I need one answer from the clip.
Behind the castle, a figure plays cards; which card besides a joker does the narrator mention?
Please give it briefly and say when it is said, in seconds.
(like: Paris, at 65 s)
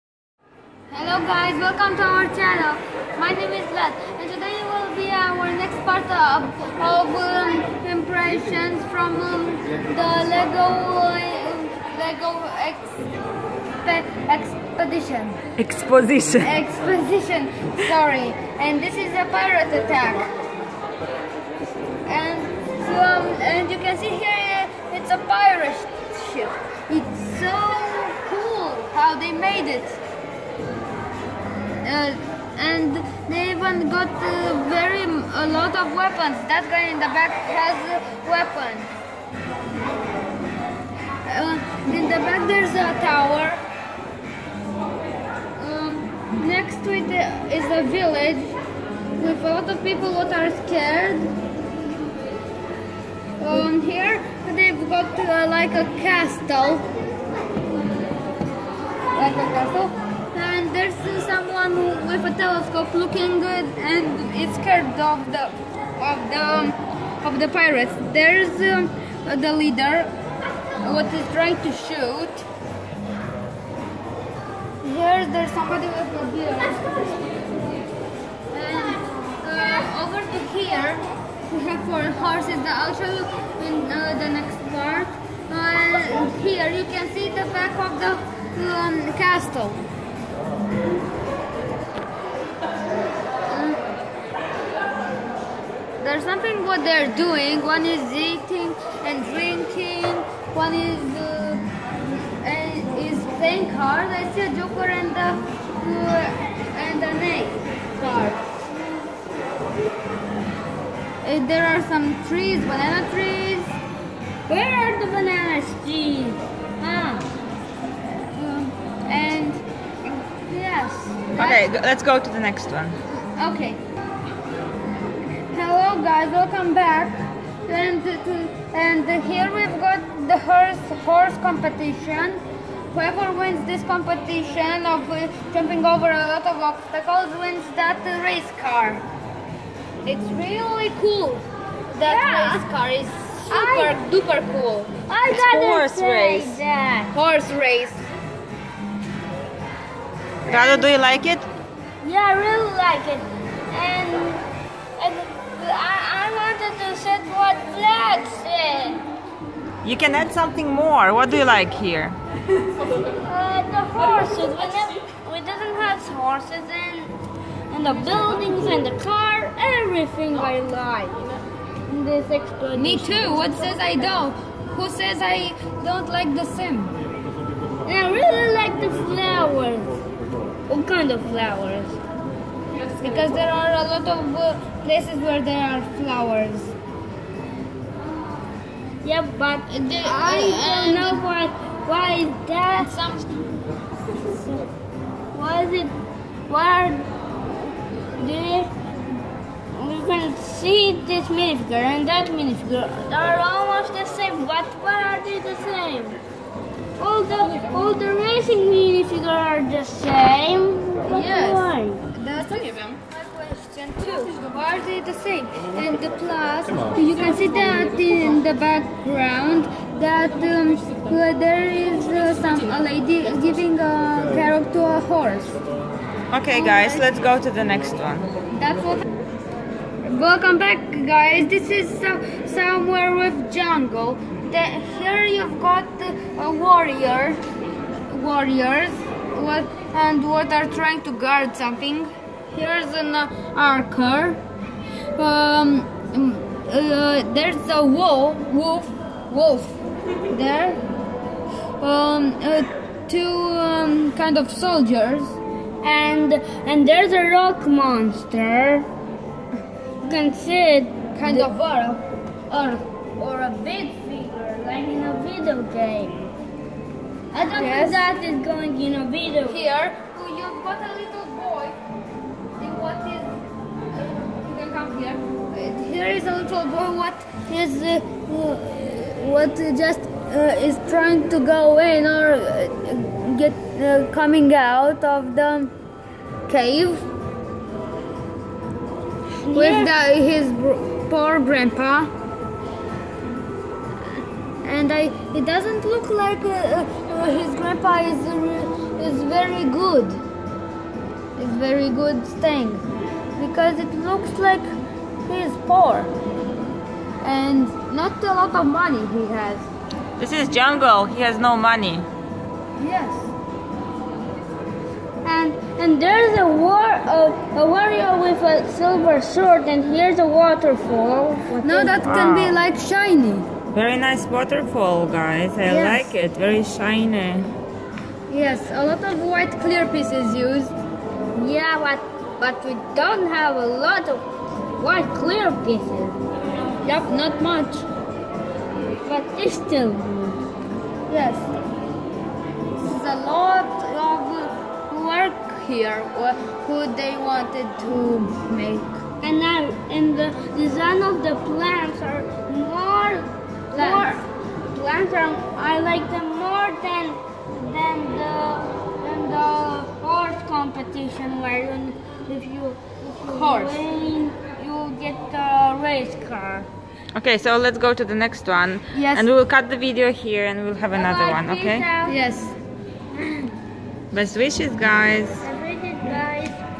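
neck card, at 107 s.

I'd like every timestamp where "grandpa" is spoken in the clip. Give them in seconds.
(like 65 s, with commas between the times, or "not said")
291 s, 297 s.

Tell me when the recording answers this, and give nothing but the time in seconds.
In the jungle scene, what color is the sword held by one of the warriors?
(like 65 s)
318 s.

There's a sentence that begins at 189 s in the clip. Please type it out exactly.
Yeah, but the, I don't know why.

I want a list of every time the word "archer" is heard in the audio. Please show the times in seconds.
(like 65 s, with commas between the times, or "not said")
243 s.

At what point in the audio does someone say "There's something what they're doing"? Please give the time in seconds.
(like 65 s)
96 s.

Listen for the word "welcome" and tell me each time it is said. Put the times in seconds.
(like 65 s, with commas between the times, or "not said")
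1 s, 126 s, 230 s.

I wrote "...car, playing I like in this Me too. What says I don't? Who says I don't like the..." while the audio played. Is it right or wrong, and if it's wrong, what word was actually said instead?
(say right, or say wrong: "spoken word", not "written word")
wrong: "everything", not "playing".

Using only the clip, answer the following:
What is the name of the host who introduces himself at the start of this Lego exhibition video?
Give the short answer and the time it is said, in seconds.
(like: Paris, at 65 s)
Vlad, at 3 s.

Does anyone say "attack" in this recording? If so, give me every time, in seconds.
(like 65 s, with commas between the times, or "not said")
19 s.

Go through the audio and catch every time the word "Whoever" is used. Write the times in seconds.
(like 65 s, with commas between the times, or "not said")
132 s.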